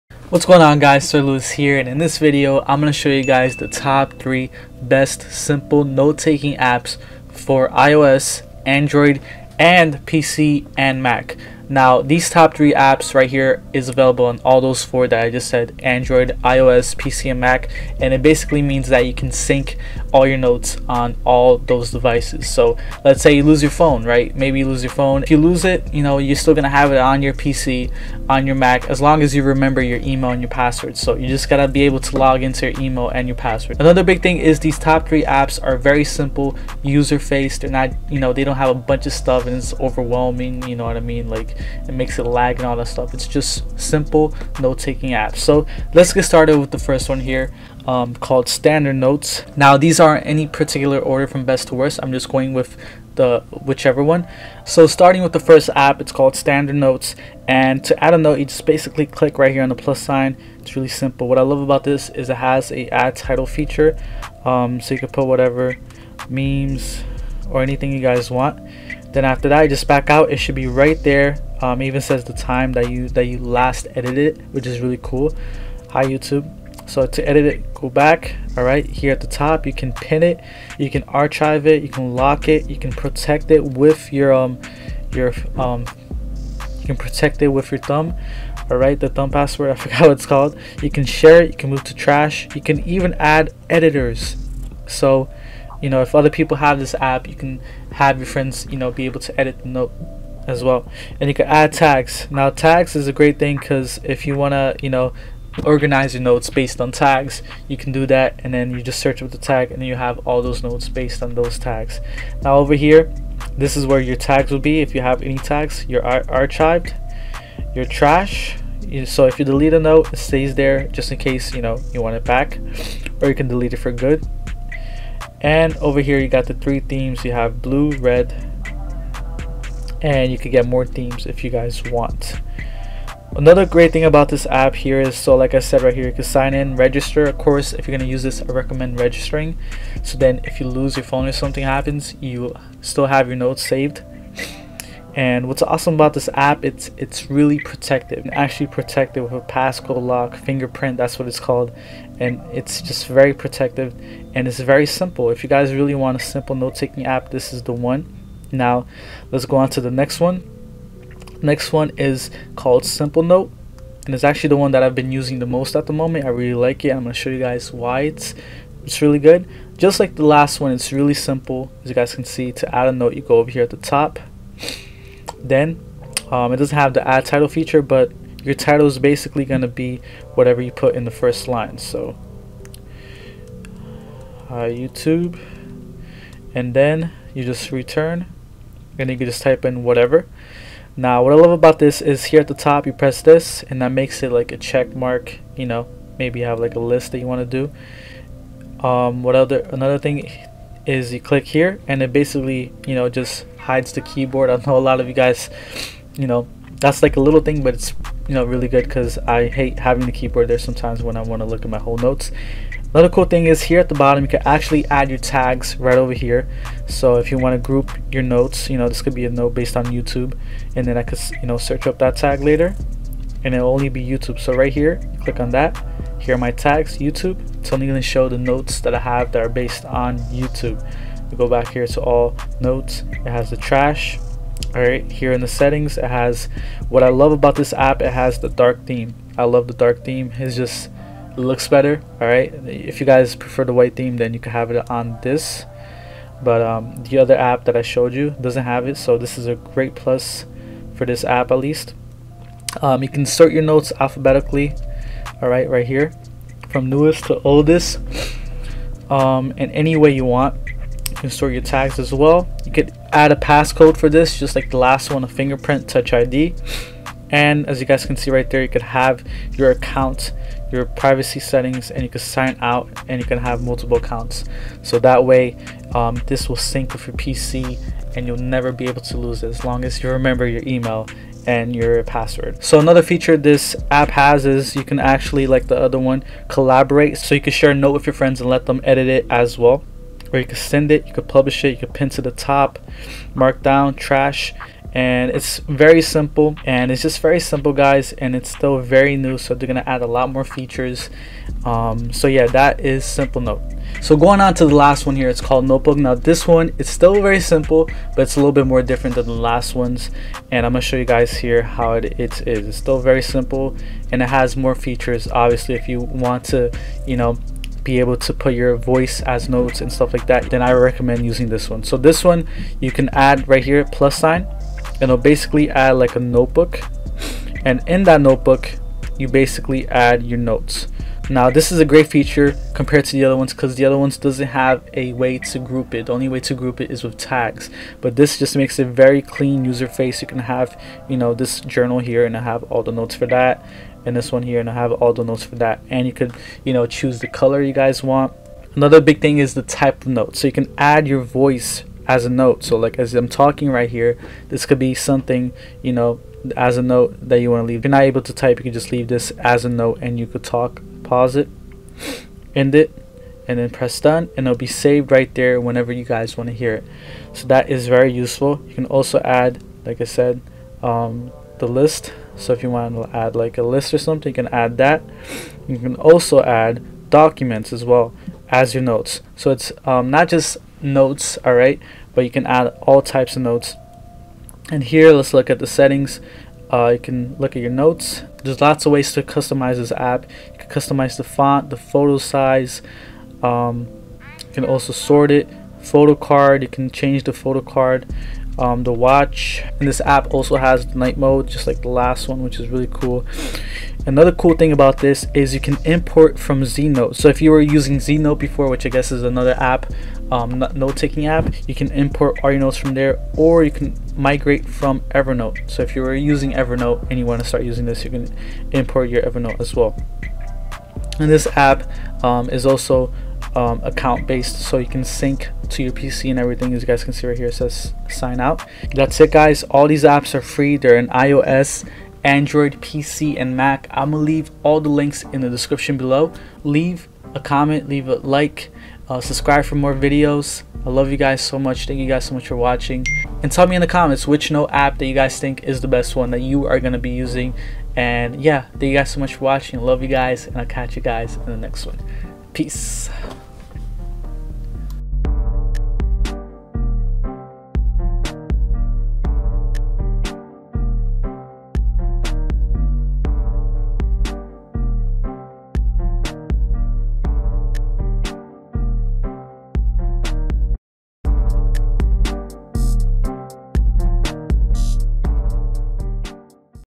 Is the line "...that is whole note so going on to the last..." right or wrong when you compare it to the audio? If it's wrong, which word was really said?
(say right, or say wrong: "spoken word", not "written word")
wrong: "simple", not "whole".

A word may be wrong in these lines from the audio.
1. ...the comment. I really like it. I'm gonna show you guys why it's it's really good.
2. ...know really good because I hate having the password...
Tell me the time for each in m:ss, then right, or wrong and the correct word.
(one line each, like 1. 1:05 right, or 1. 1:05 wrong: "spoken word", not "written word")
1. 2:45 wrong: "moment", not "comment"
2. 3:28 wrong: "keyboard", not "password".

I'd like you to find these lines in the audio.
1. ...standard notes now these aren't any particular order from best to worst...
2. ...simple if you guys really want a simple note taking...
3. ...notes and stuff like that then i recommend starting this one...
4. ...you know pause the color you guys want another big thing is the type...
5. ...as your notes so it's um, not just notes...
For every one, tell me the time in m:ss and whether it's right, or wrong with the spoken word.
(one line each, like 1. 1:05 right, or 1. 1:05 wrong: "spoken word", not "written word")
1. 0:48 right
2. 2:34 right
3. 5:19 wrong: "using", not "starting"
4. 5:46 wrong: "choose", not "pause"
5. 6:18 right.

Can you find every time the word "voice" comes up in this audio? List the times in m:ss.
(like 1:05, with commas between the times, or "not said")
5:18, 5:51.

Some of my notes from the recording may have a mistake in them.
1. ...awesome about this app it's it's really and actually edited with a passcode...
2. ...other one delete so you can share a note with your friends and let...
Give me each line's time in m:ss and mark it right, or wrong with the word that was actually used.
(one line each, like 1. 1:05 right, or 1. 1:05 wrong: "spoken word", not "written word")
1. 2:25 wrong: "protected", not "edited"
2. 4:45 wrong: "collaborate", not "delete".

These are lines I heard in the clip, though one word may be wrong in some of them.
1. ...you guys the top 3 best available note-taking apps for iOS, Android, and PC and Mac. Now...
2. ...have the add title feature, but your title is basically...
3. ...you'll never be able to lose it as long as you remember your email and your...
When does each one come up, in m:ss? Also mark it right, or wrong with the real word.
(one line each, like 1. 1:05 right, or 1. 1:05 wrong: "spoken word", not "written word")
1. 0:03 wrong: "simple", not "available"
2. 2:56 right
3. 4:38 right.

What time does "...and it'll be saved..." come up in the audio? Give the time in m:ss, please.
6:04.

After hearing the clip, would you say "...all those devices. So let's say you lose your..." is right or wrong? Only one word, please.
right.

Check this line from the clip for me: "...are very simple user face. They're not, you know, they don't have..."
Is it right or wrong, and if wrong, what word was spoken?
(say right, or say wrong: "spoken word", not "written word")
right.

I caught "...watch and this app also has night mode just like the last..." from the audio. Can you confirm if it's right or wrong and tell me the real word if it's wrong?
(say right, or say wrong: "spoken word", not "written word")
right.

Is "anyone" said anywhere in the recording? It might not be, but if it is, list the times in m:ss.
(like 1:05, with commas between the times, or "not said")
not said.